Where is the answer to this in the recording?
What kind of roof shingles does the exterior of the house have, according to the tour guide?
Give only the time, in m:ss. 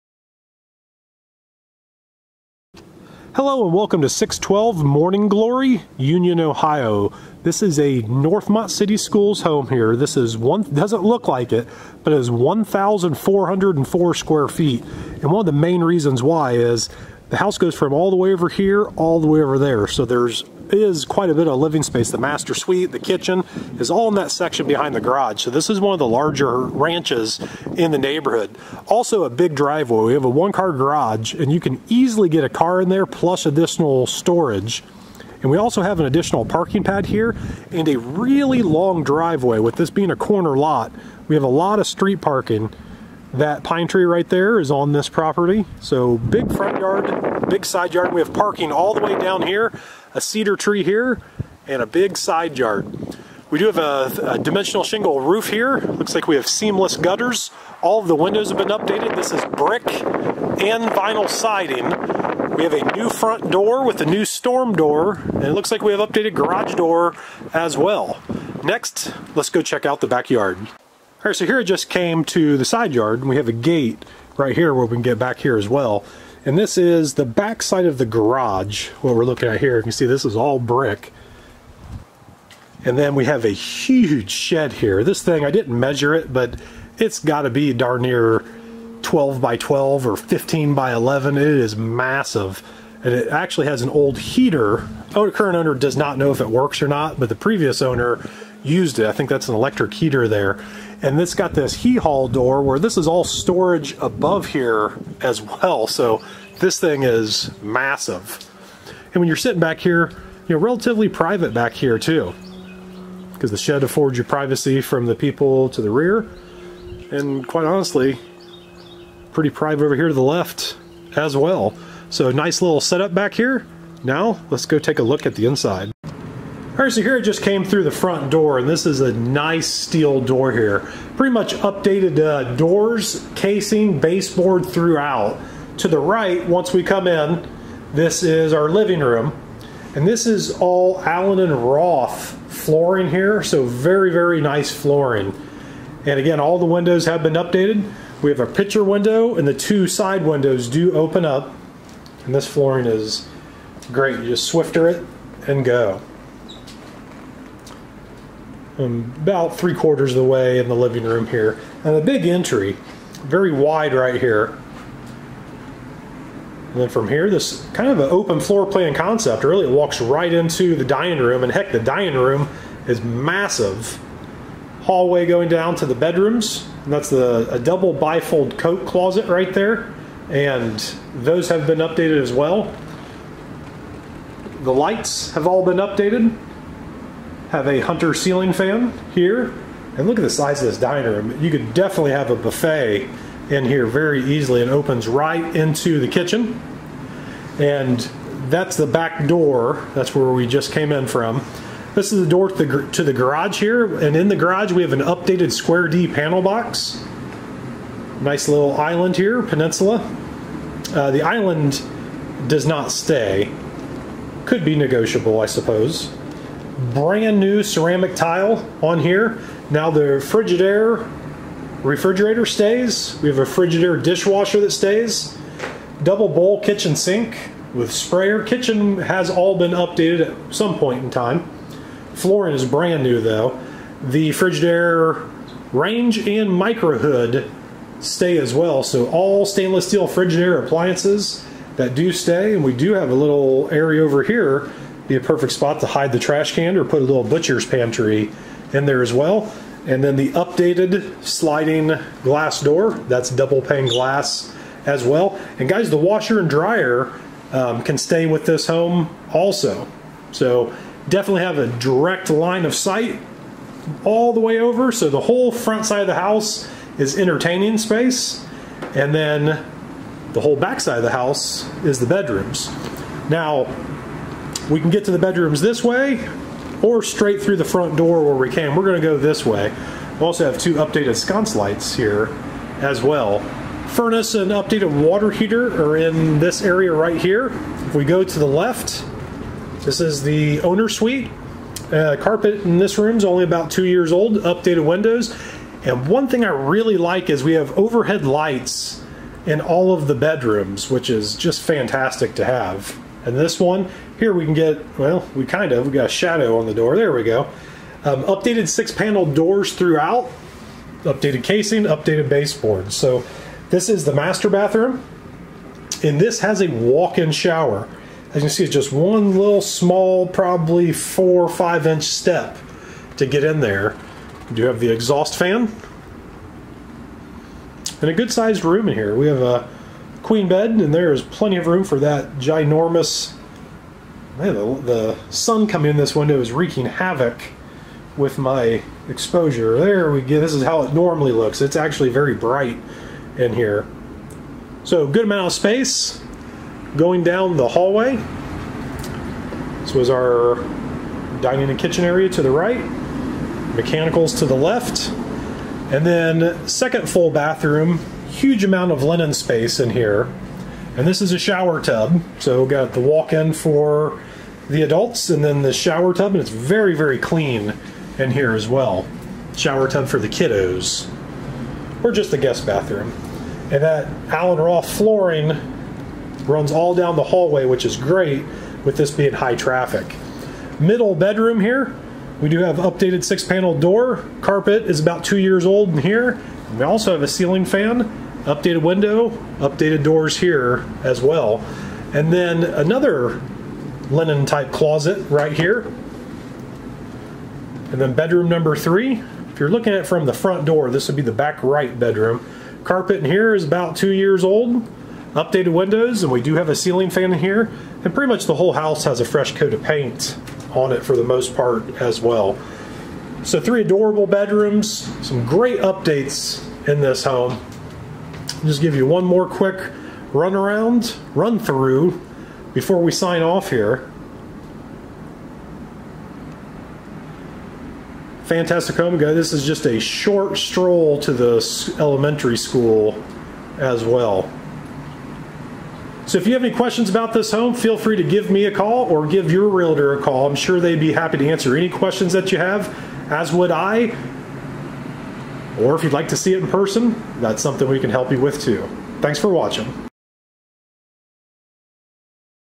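0:54.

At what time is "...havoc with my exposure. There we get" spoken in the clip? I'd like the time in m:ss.
5:36.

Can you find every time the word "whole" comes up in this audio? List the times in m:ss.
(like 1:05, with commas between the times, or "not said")
4:25, 4:30, 6:48.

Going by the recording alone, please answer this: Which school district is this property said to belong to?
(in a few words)
Northmont City Schools.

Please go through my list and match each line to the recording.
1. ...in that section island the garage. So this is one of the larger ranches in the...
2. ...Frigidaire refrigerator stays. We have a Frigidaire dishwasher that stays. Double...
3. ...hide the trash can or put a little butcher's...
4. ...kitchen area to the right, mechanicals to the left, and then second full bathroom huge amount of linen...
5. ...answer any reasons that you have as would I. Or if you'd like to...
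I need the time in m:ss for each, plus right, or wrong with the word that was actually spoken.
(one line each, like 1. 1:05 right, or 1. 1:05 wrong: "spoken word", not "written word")
1. 0:24 wrong: "behind", not "island"
2. 3:40 right
3. 4:05 right
4. 5:51 right
5. 7:21 wrong: "questions", not "reasons".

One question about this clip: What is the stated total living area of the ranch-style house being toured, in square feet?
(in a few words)
1,404.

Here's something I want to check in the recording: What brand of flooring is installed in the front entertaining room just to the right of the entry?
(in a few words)
Allen and Roth.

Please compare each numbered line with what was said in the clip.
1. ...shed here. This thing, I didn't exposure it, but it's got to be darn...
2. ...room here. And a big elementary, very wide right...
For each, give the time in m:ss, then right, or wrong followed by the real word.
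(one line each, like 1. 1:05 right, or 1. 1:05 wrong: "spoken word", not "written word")
1. 1:24 wrong: "measure", not "exposure"
2. 2:41 wrong: "entry", not "elementary".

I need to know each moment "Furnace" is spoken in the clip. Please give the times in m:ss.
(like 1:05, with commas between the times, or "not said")
4:43.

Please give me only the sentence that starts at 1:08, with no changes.
Next, let's go check out the backyard.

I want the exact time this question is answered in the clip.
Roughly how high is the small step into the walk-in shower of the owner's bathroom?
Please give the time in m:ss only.
5:20.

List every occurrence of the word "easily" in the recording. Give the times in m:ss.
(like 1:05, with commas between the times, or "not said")
0:31, 3:14.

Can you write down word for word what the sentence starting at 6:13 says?
And that Allen Roth flooring runs all down the hallway, which is great with this being high traffic.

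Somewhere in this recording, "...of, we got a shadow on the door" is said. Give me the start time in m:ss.
5:05.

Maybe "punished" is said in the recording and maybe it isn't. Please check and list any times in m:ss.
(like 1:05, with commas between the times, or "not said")
not said.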